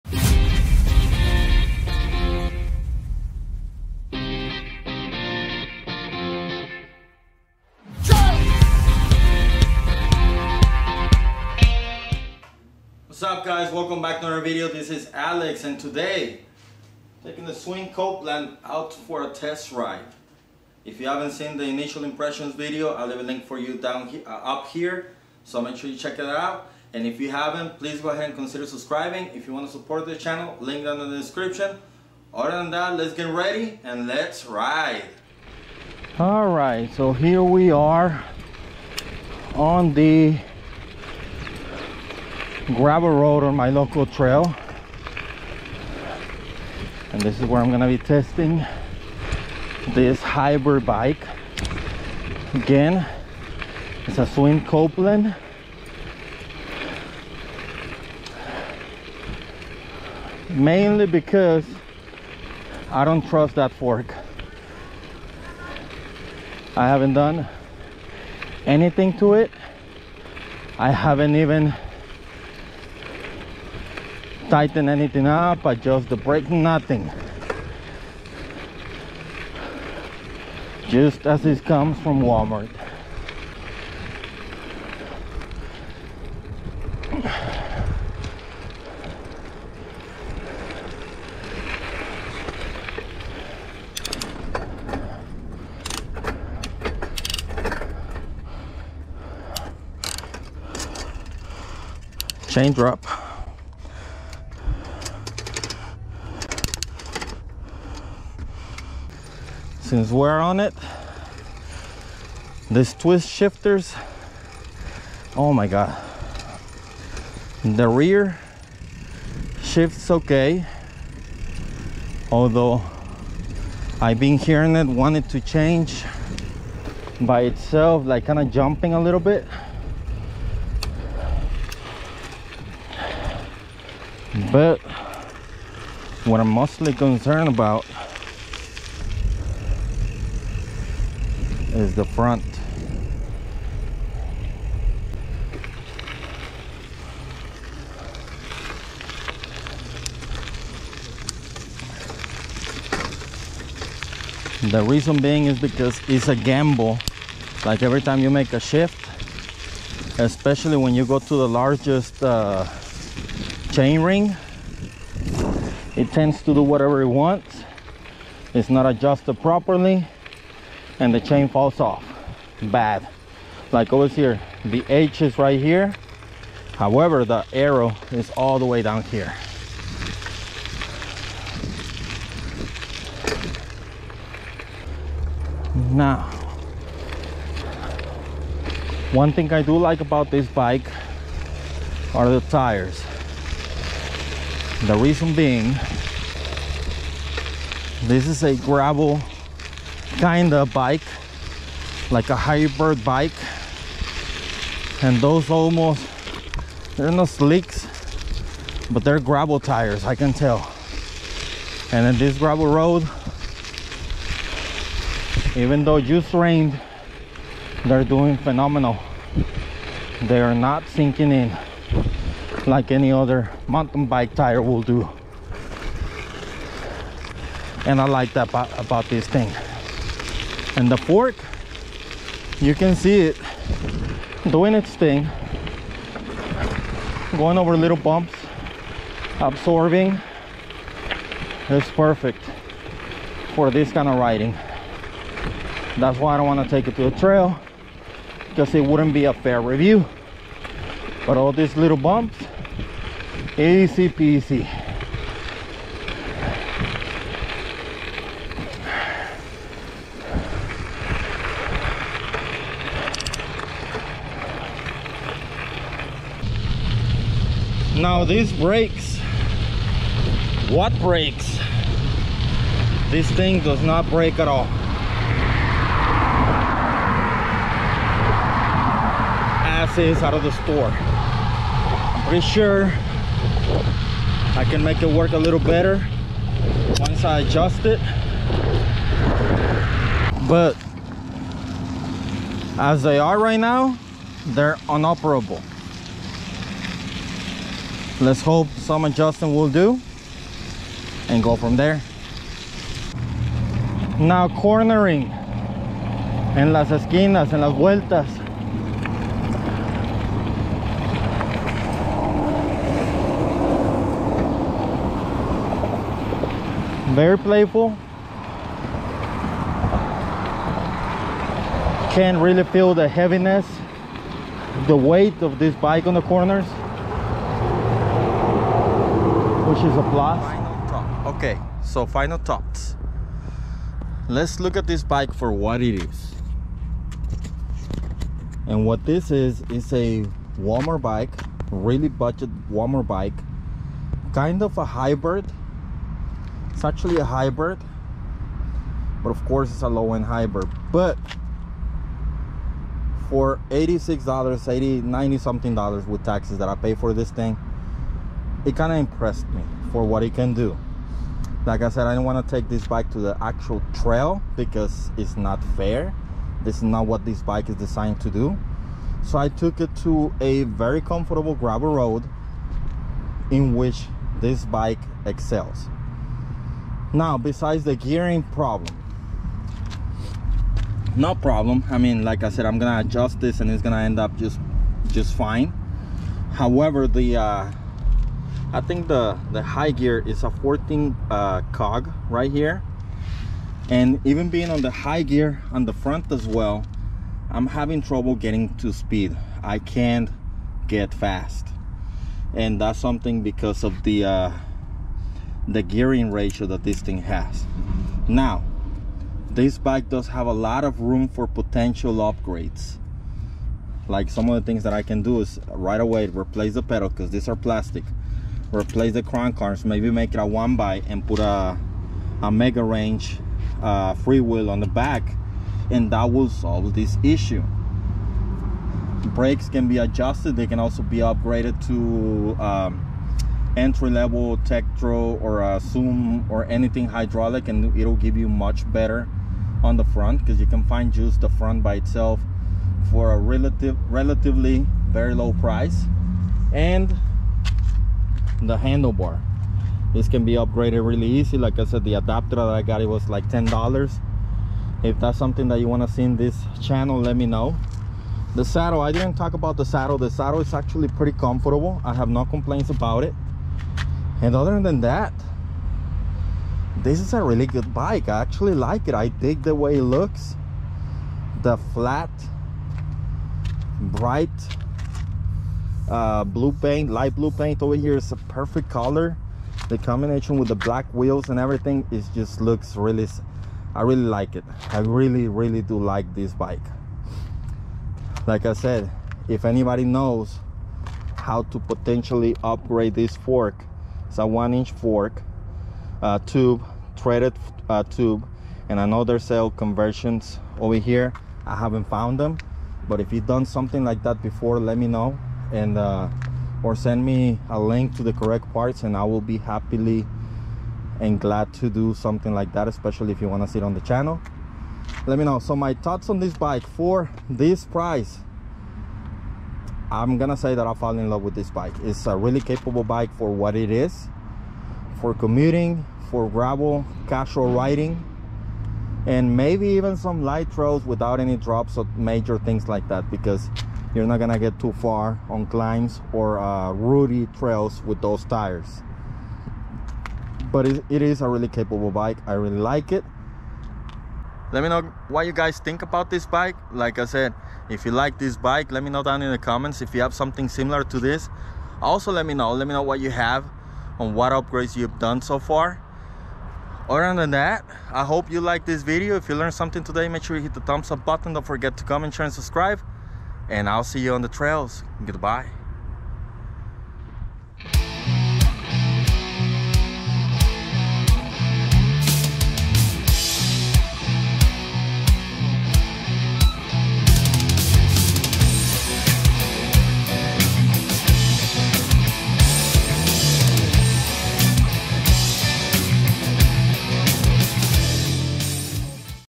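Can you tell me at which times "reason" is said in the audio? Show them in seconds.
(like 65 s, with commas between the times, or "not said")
154 s, 194 s.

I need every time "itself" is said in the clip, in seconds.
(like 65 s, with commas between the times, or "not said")
127 s, 441 s.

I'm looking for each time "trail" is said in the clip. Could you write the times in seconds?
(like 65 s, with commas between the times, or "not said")
44 s, 247 s, 363 s, 537 s, 564 s.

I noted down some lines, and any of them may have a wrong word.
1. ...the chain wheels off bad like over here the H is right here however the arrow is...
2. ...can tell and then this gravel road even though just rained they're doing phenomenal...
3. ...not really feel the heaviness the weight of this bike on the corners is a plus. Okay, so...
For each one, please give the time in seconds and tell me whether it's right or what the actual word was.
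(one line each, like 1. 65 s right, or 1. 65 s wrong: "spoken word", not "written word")
1. 171 s wrong: "falls", not "wheels"
2. 210 s right
3. 322 s right.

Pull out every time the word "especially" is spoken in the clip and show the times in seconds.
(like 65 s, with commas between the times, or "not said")
160 s, 512 s.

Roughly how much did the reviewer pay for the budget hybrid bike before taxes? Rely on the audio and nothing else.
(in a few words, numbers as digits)
$86.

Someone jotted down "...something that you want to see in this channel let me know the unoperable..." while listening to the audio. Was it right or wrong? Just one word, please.
wrong.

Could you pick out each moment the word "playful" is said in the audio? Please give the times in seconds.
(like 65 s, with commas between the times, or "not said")
317 s.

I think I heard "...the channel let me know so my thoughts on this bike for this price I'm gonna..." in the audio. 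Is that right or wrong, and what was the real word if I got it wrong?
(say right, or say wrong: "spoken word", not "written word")
right.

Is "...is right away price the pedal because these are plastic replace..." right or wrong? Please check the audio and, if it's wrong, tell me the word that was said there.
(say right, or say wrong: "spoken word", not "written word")
wrong: "replace", not "price".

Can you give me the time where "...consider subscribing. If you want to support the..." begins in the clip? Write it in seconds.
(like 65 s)
28 s.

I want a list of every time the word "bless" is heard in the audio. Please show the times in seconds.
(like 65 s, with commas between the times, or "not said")
not said.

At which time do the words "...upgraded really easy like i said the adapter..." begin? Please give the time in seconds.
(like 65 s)
450 s.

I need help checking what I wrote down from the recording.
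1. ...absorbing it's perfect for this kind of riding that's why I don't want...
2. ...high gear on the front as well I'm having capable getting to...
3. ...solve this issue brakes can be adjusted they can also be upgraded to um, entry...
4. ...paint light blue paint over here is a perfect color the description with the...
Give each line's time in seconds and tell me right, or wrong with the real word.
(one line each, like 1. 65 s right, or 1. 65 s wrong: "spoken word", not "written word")
1. 239 s right
2. 394 s wrong: "trouble", not "capable"
3. 426 s right
4. 476 s wrong: "combination", not "description".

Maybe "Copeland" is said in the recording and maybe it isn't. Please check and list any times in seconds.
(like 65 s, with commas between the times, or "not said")
17 s, 54 s.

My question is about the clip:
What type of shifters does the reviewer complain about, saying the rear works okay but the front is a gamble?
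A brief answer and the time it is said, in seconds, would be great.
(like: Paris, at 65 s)
twist shifters, at 112 s.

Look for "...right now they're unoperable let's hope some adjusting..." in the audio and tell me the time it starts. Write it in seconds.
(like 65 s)
293 s.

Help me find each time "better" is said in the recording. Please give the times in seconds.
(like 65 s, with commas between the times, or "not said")
285 s, 438 s.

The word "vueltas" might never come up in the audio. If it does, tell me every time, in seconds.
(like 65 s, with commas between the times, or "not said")
307 s.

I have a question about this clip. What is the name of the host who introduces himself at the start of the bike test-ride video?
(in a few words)
Alex.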